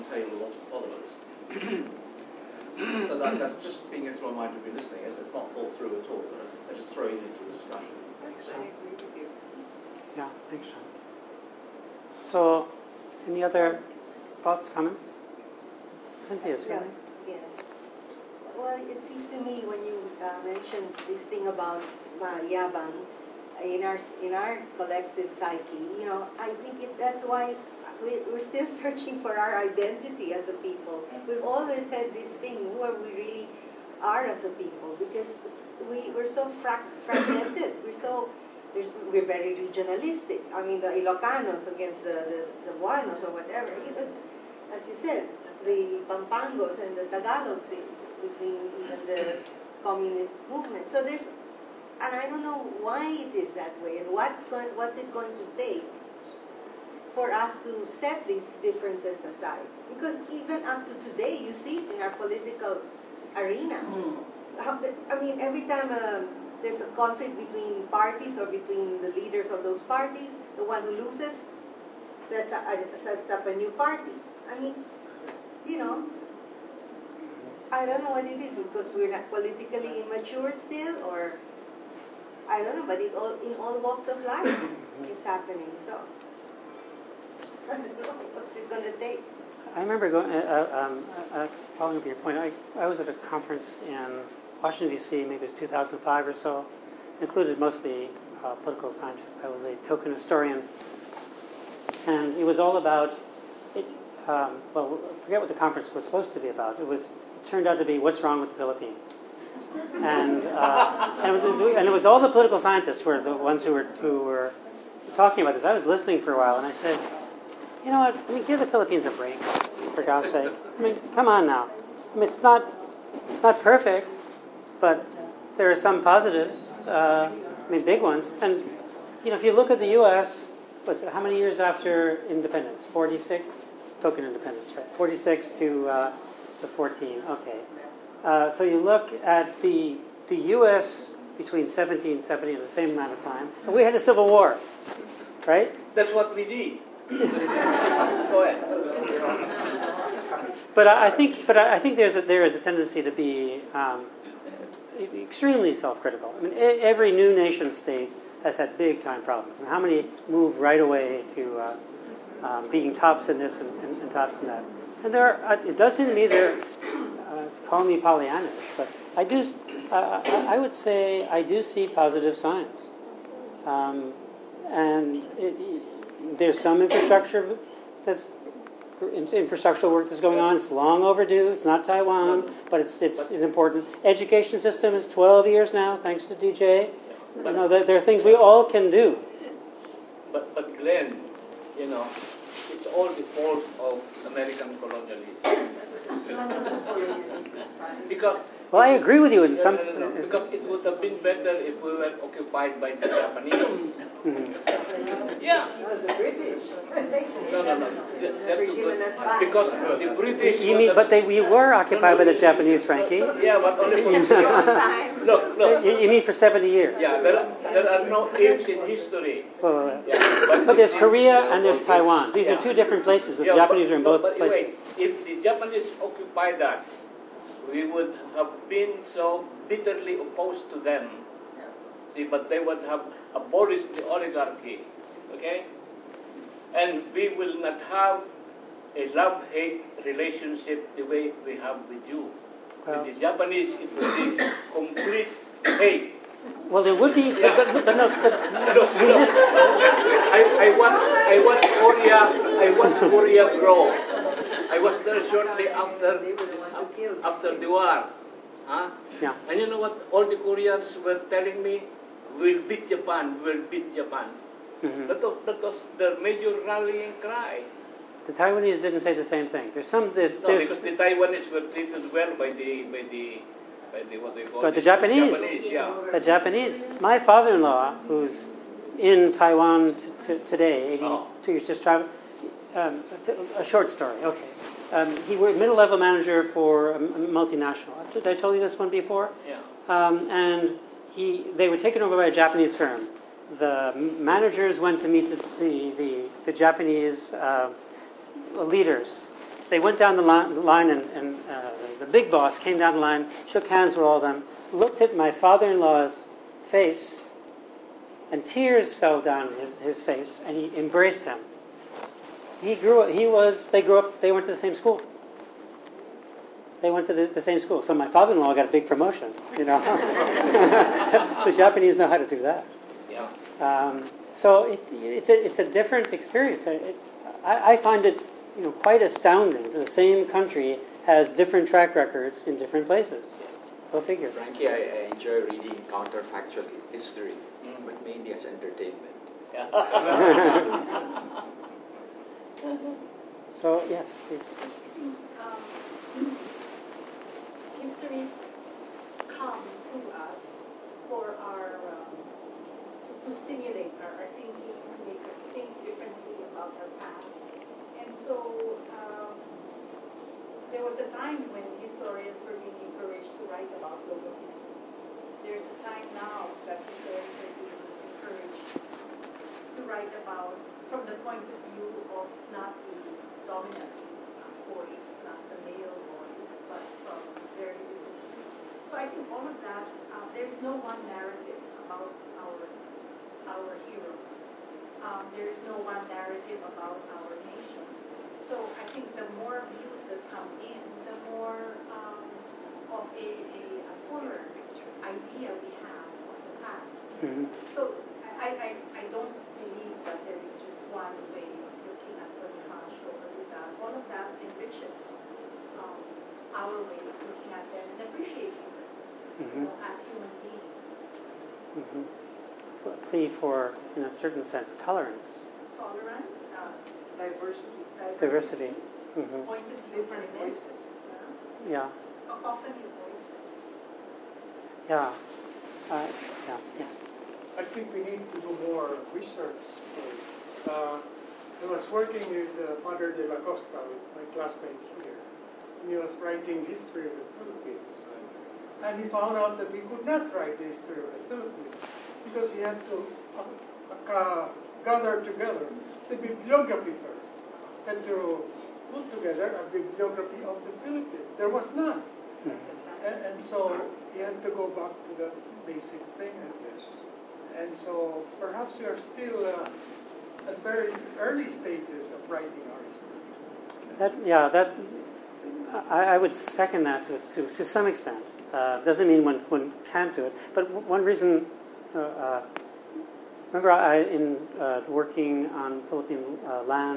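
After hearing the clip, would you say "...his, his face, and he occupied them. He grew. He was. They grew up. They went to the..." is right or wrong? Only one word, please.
wrong.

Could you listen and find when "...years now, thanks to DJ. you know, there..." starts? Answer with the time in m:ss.
3:05.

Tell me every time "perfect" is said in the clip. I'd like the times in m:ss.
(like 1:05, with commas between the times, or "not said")
2:03.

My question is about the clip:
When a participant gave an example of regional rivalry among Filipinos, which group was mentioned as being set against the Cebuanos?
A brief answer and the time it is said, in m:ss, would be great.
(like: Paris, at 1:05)
Ilocanos, at 0:40.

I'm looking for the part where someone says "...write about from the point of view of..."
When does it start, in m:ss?
6:09.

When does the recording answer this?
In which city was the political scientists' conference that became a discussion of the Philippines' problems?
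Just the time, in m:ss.
1:34.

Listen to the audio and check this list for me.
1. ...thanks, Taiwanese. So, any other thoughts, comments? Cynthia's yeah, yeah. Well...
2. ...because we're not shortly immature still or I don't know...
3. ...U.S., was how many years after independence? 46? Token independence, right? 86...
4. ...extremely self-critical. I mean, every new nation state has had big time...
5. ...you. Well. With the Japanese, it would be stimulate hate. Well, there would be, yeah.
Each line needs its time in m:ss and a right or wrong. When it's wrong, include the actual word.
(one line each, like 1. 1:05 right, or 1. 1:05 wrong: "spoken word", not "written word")
1. 0:10 wrong: "Sean", not "Taiwanese"
2. 1:18 wrong: "politically", not "shortly"
3. 2:10 wrong: "46", not "86"
4. 2:35 right
5. 4:02 wrong: "complete", not "stimulate".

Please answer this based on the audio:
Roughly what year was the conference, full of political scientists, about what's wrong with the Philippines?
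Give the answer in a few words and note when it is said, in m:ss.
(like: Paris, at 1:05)
2005, at 1:35.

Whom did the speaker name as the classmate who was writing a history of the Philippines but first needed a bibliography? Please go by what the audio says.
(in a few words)
Father de la Costa.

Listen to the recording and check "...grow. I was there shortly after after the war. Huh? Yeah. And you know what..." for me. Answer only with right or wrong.
right.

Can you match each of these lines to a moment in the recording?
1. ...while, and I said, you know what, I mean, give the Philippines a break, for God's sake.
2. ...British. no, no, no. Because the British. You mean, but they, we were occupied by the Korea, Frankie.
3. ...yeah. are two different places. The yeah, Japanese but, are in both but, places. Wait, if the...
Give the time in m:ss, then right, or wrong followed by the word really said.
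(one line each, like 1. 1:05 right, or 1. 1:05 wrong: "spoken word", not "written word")
1. 1:56 right
2. 3:26 wrong: "Japanese", not "Korea"
3. 3:42 right.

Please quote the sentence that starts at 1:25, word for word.
So I don't know what's it going to take.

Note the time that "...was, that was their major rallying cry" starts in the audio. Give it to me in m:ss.
4:25.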